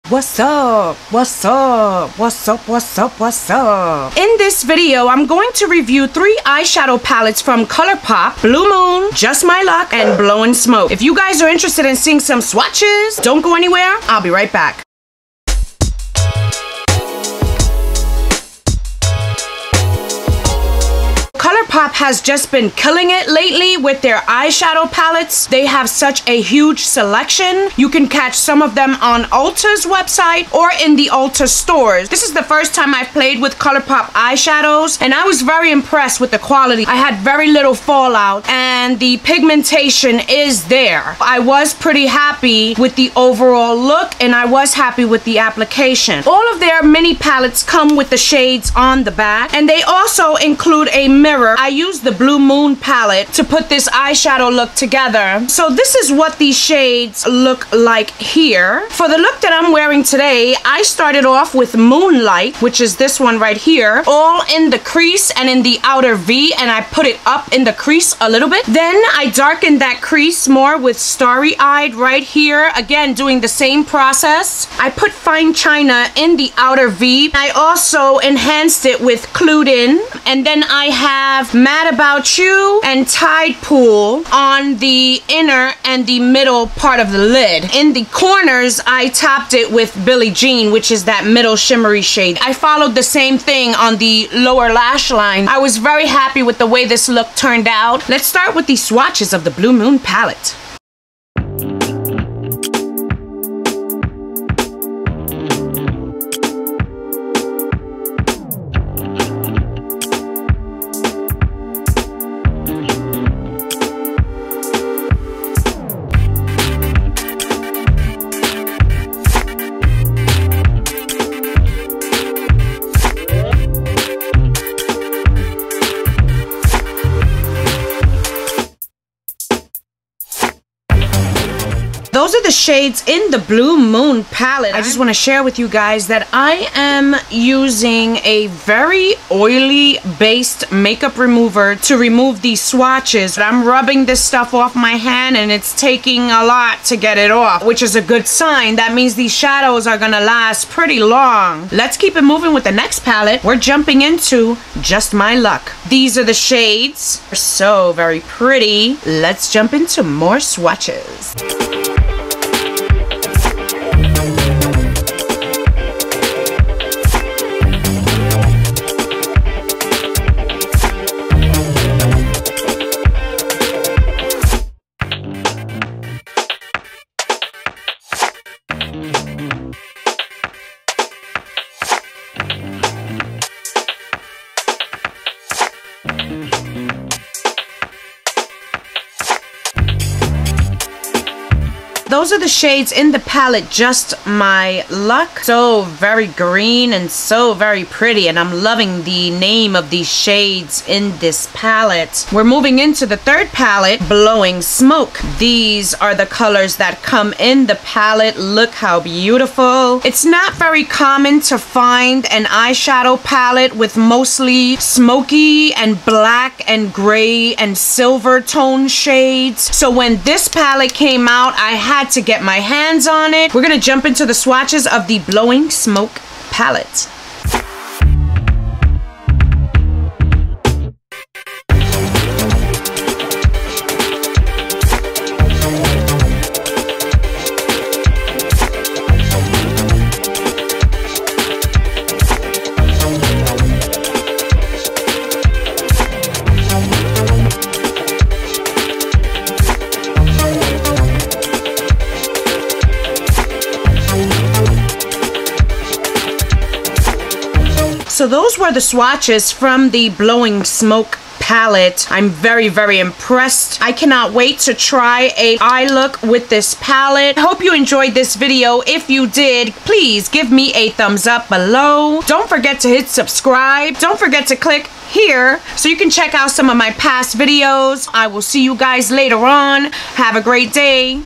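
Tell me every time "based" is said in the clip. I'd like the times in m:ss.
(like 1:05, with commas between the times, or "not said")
2:20.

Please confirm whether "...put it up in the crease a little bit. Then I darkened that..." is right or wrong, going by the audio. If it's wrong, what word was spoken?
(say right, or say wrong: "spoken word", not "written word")
right.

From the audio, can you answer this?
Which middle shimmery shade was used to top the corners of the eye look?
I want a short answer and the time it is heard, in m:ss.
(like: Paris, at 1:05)
Billie Jean, at 1:30.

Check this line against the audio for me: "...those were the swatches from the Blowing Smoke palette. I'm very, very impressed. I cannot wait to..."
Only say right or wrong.
right.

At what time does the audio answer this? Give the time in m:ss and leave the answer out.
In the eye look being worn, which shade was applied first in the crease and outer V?
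1:01.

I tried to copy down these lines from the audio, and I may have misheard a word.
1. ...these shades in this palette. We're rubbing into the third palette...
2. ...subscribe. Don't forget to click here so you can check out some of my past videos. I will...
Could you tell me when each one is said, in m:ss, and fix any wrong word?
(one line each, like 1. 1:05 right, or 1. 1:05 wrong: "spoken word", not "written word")
1. 3:19 wrong: "moving", not "rubbing"
2. 4:33 right.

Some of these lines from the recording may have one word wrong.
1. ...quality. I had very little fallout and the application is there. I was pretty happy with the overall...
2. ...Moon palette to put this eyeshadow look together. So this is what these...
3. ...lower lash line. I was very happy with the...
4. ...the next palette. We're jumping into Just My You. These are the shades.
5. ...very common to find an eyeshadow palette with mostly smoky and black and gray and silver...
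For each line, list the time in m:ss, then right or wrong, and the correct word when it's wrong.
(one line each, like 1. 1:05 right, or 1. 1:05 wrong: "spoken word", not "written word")
1. 0:36 wrong: "pigmentation", not "application"
2. 0:52 right
3. 1:34 right
4. 2:32 wrong: "Luck", not "You"
5. 3:30 right.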